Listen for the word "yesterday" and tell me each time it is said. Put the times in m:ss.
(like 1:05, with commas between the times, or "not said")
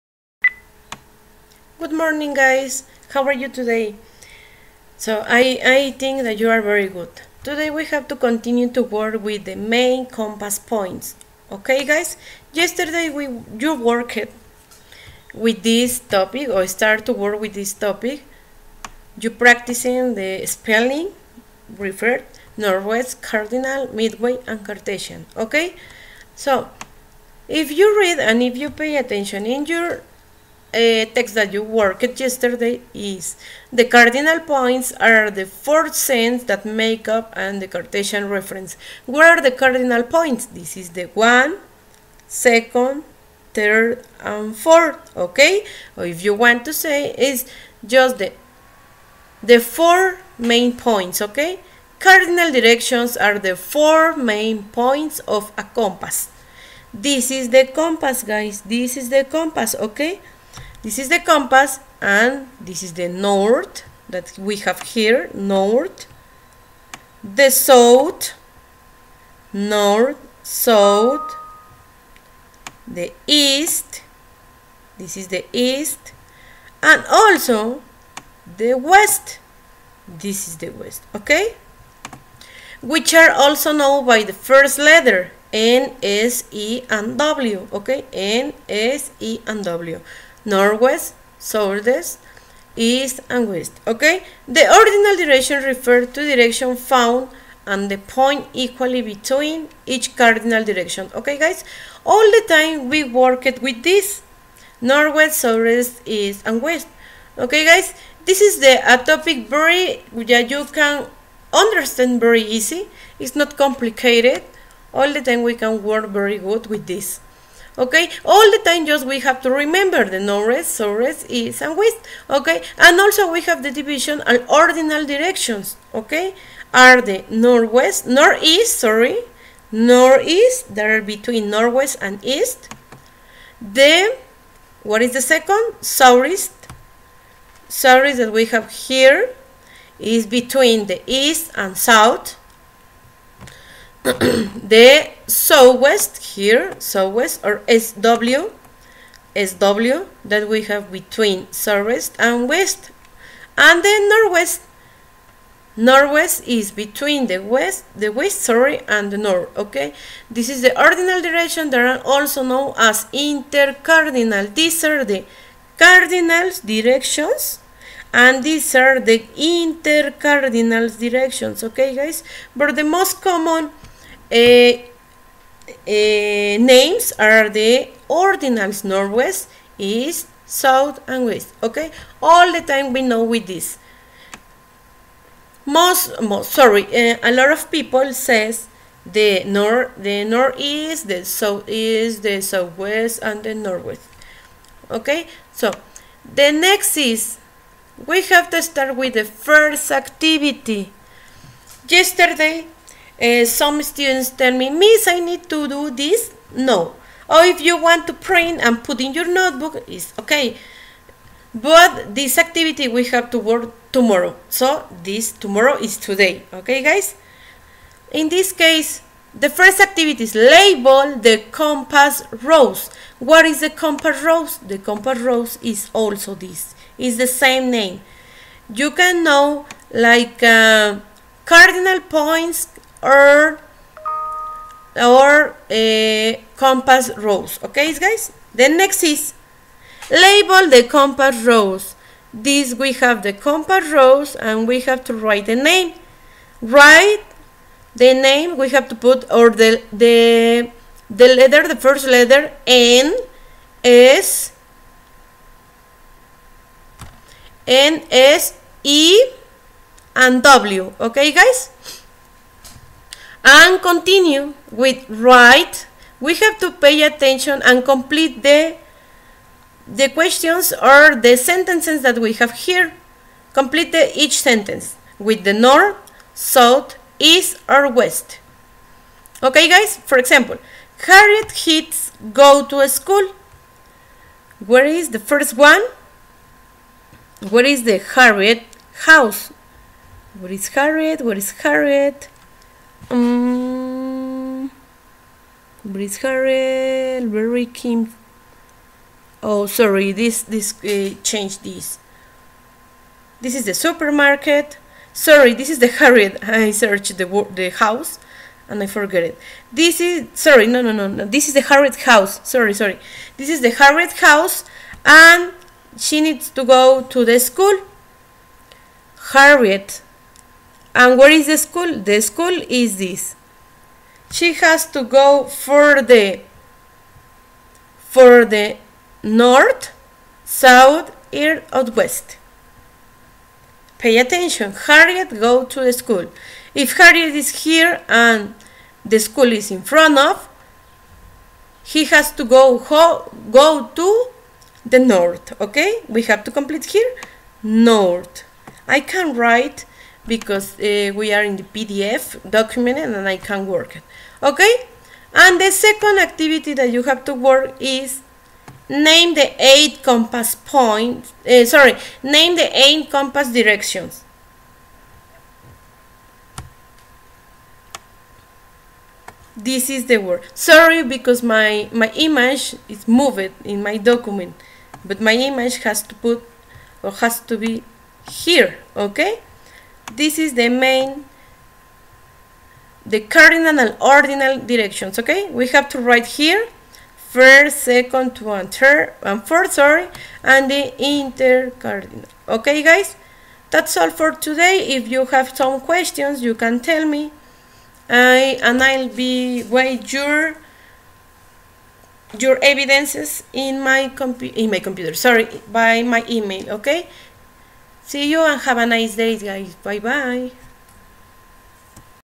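0:12, 0:32, 3:21.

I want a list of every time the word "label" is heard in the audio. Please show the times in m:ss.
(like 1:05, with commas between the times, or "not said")
3:40, 4:00.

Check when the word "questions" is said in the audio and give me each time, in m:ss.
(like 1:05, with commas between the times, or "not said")
4:30, 6:35.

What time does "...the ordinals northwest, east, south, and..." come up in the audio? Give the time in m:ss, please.
2:57.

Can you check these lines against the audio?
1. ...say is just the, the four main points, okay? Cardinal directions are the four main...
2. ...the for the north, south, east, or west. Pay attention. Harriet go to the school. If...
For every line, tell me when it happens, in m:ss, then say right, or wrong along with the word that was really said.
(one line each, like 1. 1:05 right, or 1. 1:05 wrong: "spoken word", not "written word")
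1. 0:46 right
2. 5:26 right.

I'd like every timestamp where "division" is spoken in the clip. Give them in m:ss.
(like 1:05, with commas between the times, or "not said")
2:03.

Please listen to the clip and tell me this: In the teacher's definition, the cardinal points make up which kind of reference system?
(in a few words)
Cartesian reference.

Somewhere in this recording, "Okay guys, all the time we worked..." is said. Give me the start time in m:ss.
1:41.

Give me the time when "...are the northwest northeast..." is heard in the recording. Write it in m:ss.
2:06.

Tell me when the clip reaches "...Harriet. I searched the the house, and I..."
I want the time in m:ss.
5:05.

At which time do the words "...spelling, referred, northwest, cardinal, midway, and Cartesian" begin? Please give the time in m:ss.
0:20.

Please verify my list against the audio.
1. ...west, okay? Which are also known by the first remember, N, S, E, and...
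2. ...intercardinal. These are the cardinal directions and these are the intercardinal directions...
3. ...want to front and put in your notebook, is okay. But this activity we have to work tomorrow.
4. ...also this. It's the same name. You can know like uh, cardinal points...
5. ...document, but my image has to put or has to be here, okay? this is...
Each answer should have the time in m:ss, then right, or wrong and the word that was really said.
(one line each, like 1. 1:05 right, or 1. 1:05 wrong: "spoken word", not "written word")
1. 1:20 wrong: "letter", not "remember"
2. 2:43 right
3. 3:27 wrong: "print", not "front"
4. 3:45 right
5. 6:13 right.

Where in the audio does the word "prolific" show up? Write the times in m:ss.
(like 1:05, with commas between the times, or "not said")
not said.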